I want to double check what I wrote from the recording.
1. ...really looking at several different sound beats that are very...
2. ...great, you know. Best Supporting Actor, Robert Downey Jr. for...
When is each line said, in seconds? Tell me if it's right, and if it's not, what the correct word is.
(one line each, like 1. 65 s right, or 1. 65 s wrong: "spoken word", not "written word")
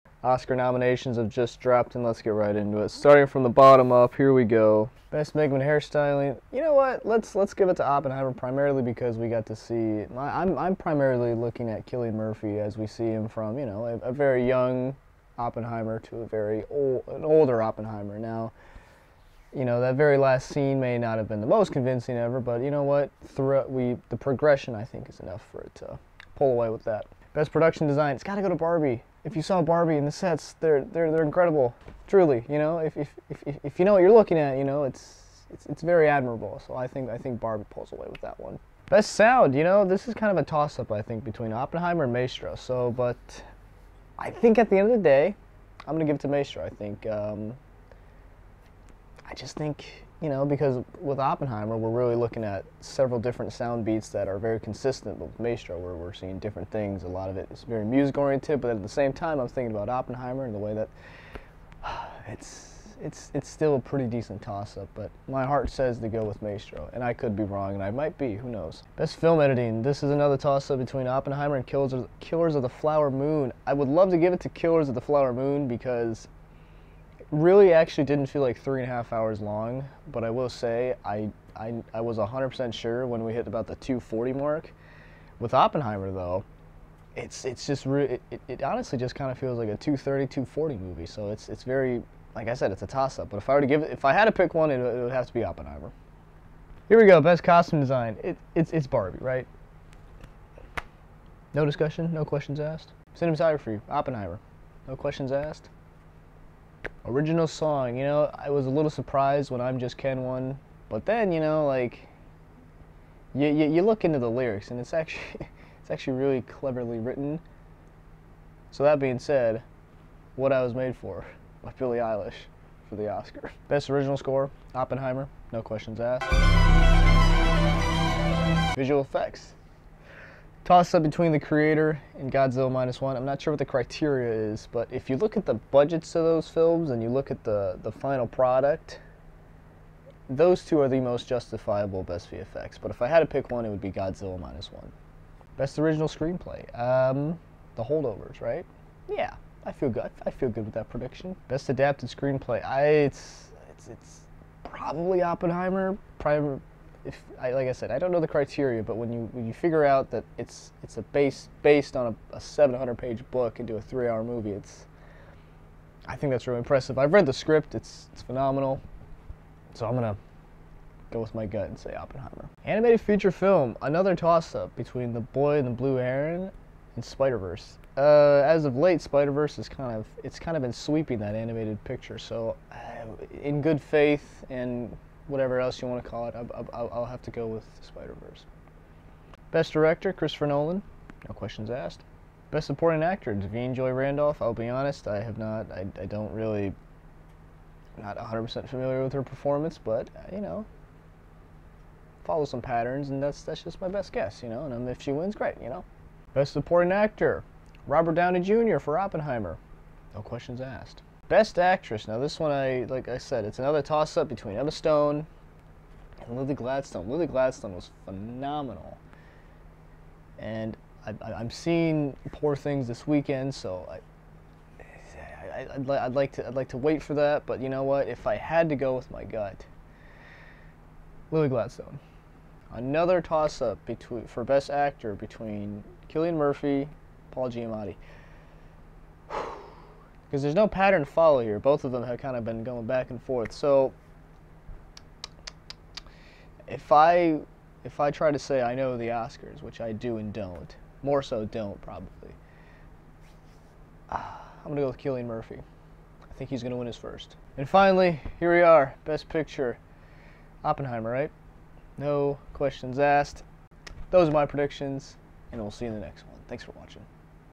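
1. 51 s right
2. 205 s right.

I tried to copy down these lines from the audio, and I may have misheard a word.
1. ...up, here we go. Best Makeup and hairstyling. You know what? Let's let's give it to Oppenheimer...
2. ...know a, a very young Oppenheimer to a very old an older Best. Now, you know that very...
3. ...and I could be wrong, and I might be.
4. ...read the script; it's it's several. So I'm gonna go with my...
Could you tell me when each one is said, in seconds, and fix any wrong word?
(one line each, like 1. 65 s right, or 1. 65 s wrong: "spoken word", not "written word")
1. 3 s right
2. 13 s wrong: "Oppenheimer", not "Best"
3. 66 s right
4. 167 s wrong: "phenomenal", not "several".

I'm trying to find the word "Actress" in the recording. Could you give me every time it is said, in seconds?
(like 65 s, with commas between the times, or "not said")
211 s.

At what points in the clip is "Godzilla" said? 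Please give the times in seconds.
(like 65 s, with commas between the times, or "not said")
132 s, 143 s.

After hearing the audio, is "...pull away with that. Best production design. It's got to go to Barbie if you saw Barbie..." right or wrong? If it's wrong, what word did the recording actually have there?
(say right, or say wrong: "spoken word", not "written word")
right.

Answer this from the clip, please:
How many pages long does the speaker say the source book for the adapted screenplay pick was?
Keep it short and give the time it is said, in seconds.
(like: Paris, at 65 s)
700, at 162 s.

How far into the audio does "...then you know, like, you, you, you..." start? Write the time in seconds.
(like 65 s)
111 s.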